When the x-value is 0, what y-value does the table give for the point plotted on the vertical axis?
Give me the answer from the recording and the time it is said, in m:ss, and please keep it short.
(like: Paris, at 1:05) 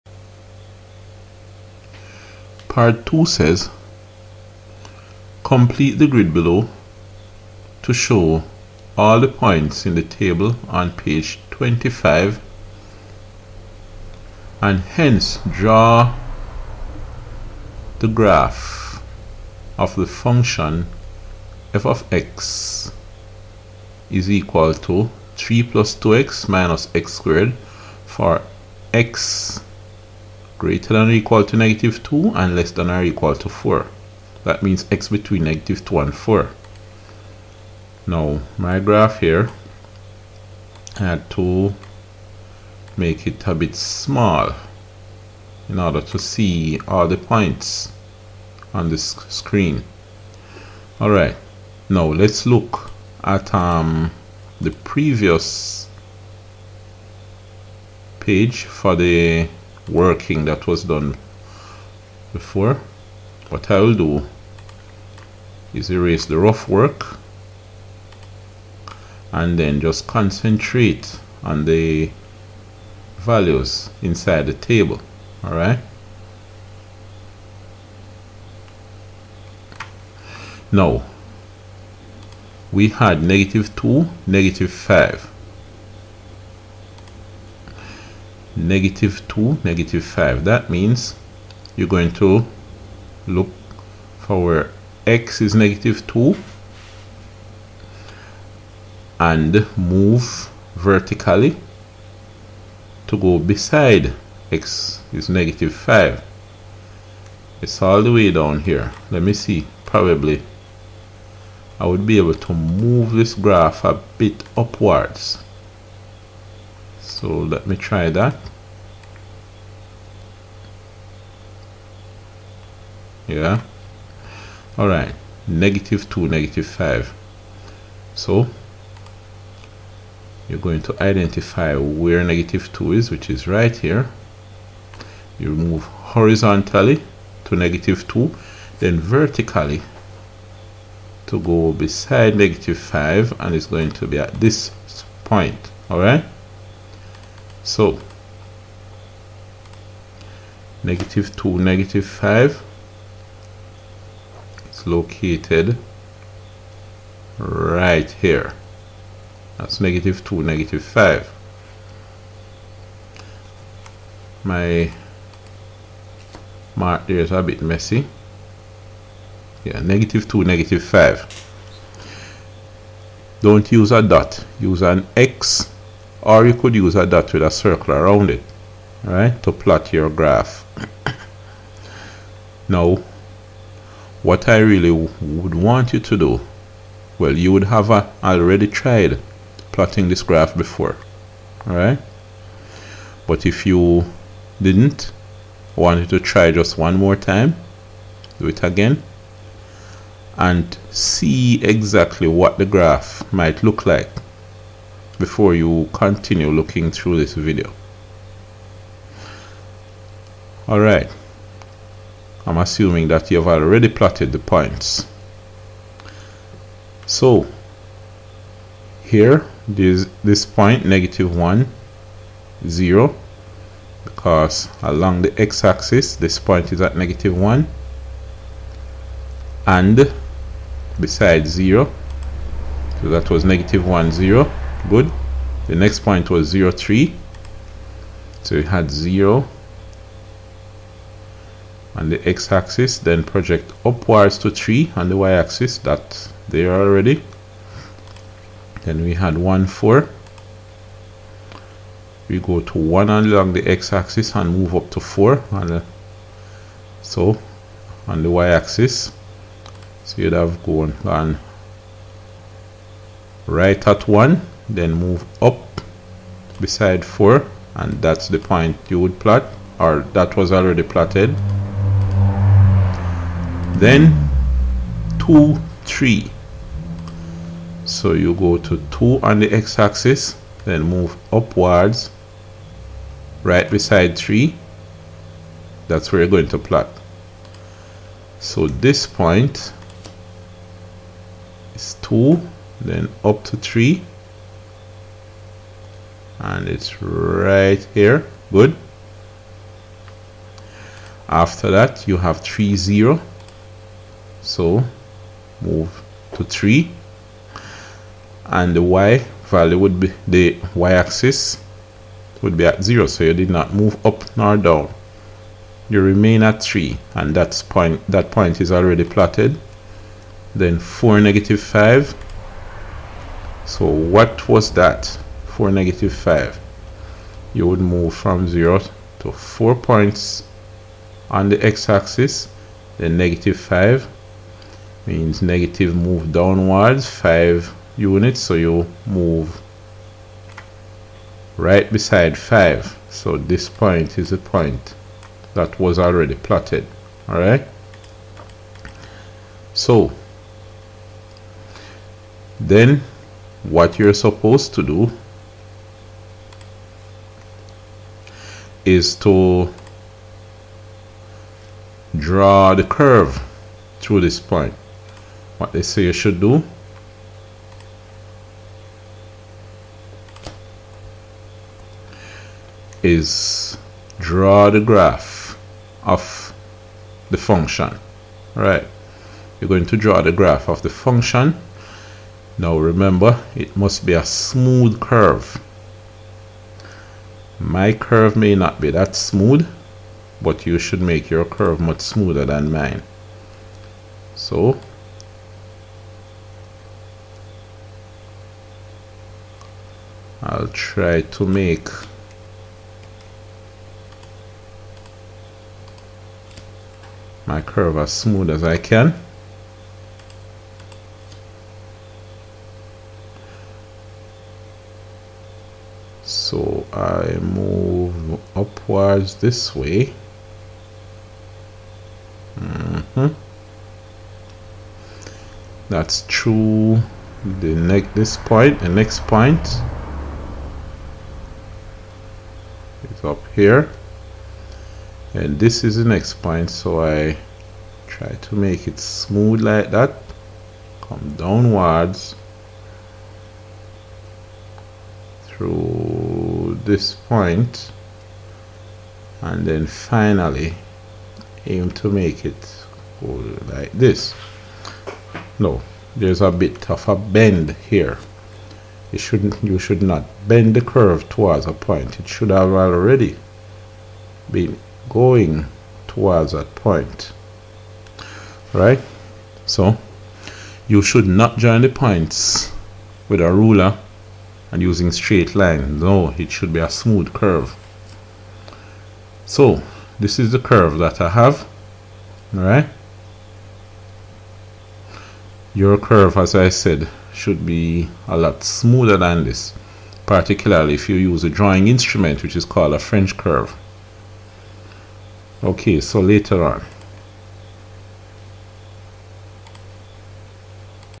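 3, at 3:56.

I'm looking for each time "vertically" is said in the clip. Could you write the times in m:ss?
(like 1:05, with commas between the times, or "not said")
1:40, 2:18.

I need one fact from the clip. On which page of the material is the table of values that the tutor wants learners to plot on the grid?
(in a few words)
25.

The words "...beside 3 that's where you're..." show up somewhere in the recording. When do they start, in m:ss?
4:43.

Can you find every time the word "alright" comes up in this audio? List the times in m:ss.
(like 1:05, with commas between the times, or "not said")
0:51, 1:15, 3:30, 5:47, 8:02.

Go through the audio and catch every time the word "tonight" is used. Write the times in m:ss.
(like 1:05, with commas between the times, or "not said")
not said.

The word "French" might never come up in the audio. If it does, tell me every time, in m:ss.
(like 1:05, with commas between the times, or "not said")
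8:12.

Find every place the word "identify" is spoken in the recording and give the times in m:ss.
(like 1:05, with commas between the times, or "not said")
2:11.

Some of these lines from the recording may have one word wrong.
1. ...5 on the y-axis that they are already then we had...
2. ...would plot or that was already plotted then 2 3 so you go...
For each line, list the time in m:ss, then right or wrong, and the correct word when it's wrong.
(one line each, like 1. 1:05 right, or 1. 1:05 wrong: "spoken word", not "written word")
1. 4:04 wrong: "3", not "5"
2. 4:28 right.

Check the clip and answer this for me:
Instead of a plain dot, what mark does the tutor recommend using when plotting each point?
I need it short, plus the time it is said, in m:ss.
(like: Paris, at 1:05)
an X, at 2:54.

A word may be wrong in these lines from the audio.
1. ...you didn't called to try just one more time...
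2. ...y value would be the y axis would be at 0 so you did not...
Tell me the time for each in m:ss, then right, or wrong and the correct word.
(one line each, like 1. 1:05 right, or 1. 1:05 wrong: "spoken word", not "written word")
1. 3:13 wrong: "wanted", not "called"
2. 5:08 right.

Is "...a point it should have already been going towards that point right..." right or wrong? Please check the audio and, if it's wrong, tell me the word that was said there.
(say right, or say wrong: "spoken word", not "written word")
right.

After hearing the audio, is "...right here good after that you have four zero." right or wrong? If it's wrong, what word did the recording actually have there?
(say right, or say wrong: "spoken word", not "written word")
wrong: "three", not "four".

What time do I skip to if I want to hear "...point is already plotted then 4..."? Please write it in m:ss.
5:18.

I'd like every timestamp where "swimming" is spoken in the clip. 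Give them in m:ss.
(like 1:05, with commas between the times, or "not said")
not said.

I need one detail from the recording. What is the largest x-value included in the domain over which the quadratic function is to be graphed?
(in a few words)
4.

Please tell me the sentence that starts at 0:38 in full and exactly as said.
Now my graph here I had to make it a bit small in order to see all the points on this screen.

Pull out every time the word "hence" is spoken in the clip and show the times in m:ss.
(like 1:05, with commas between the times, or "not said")
0:14.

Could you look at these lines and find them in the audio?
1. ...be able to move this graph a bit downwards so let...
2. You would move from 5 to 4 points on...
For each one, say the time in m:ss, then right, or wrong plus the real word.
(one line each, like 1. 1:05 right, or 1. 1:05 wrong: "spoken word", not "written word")
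1. 1:52 wrong: "upwards", not "downwards"
2. 5:27 wrong: "0", not "5".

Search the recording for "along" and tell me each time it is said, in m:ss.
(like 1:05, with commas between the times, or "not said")
3:44, 4:13.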